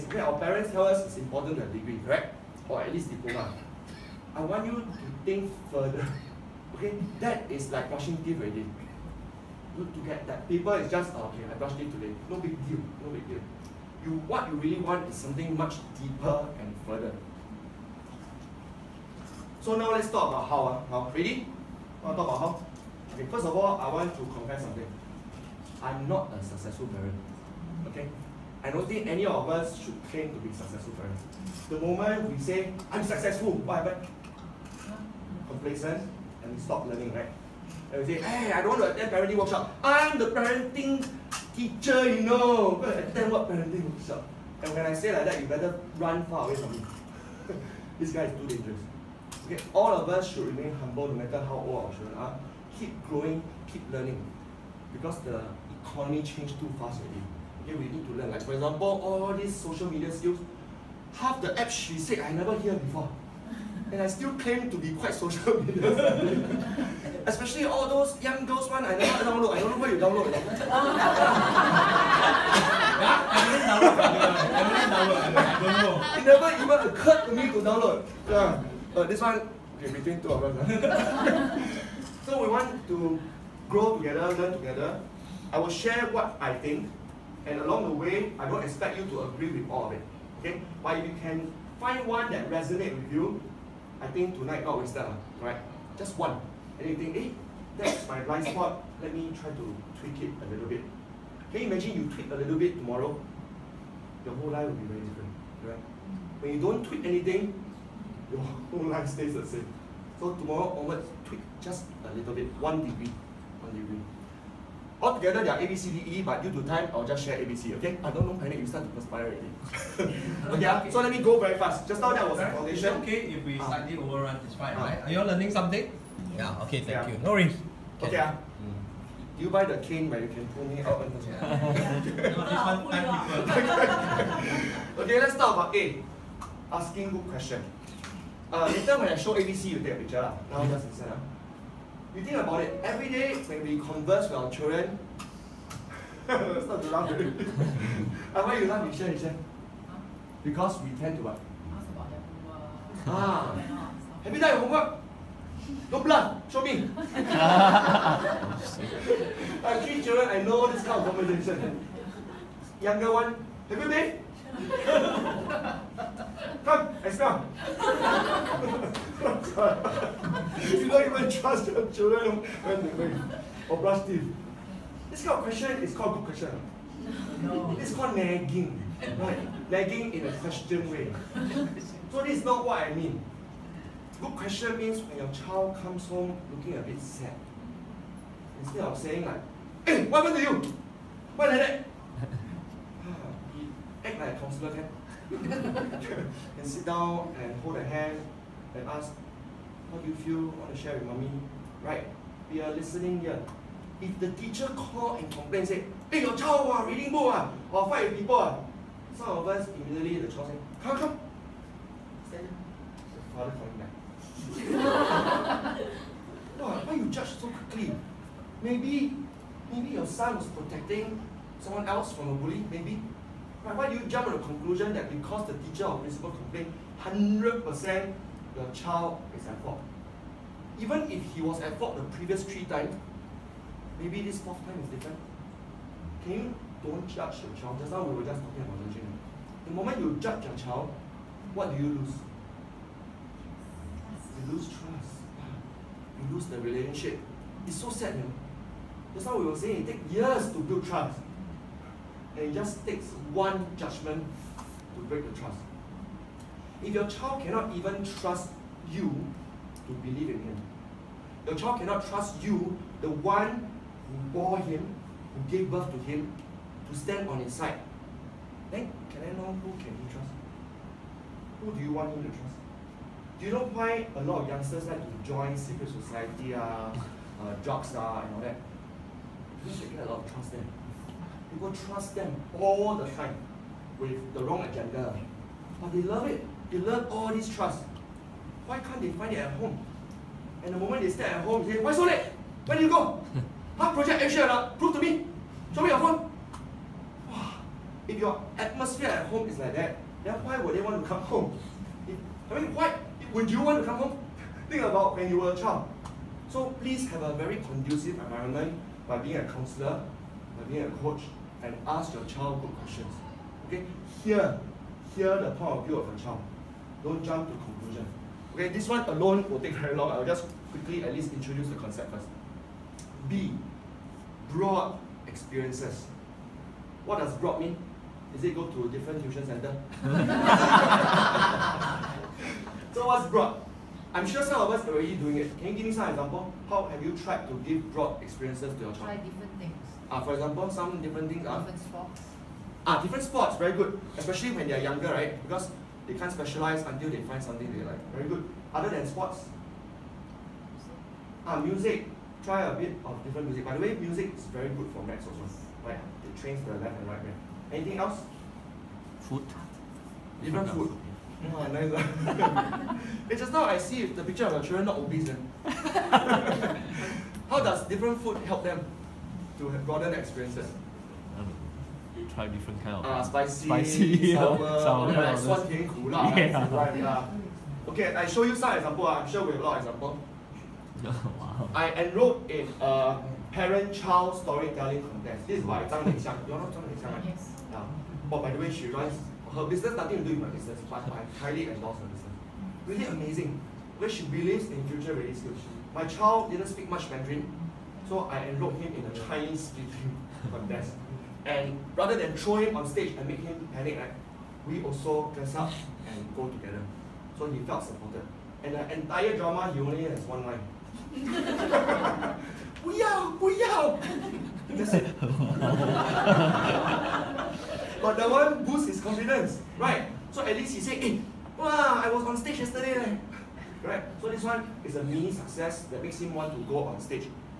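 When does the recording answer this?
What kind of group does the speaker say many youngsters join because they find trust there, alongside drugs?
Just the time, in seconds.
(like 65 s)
275 s.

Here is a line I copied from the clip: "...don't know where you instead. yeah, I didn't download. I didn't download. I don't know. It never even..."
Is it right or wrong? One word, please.
wrong.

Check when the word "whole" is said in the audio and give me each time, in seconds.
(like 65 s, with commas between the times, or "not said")
104 s, 108 s.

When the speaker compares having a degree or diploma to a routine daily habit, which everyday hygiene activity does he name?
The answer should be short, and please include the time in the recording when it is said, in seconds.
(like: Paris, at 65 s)
brushing teeth, at 7 s.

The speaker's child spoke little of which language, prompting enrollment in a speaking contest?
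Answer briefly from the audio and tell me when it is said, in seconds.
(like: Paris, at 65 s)
Mandarin, at 397 s.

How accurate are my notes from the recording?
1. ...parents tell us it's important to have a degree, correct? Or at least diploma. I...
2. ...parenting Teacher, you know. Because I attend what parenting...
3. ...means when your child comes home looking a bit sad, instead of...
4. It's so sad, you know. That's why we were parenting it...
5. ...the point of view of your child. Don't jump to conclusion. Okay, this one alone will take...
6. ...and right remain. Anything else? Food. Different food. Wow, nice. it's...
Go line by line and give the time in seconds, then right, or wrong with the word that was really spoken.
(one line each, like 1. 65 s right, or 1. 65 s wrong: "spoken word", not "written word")
1. 0 s right
2. 40 s right
3. 184 s right
4. 247 s wrong: "saying", not "parenting"
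5. 315 s right
6. 356 s wrong: "brain", not "remain".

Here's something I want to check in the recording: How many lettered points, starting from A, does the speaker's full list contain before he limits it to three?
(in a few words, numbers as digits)
5.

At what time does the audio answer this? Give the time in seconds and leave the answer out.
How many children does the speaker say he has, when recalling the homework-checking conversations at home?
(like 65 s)
159 s.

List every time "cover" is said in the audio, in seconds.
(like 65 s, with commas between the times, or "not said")
not said.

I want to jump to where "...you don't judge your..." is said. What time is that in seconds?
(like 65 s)
236 s.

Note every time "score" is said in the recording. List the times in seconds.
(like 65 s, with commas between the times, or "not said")
not said.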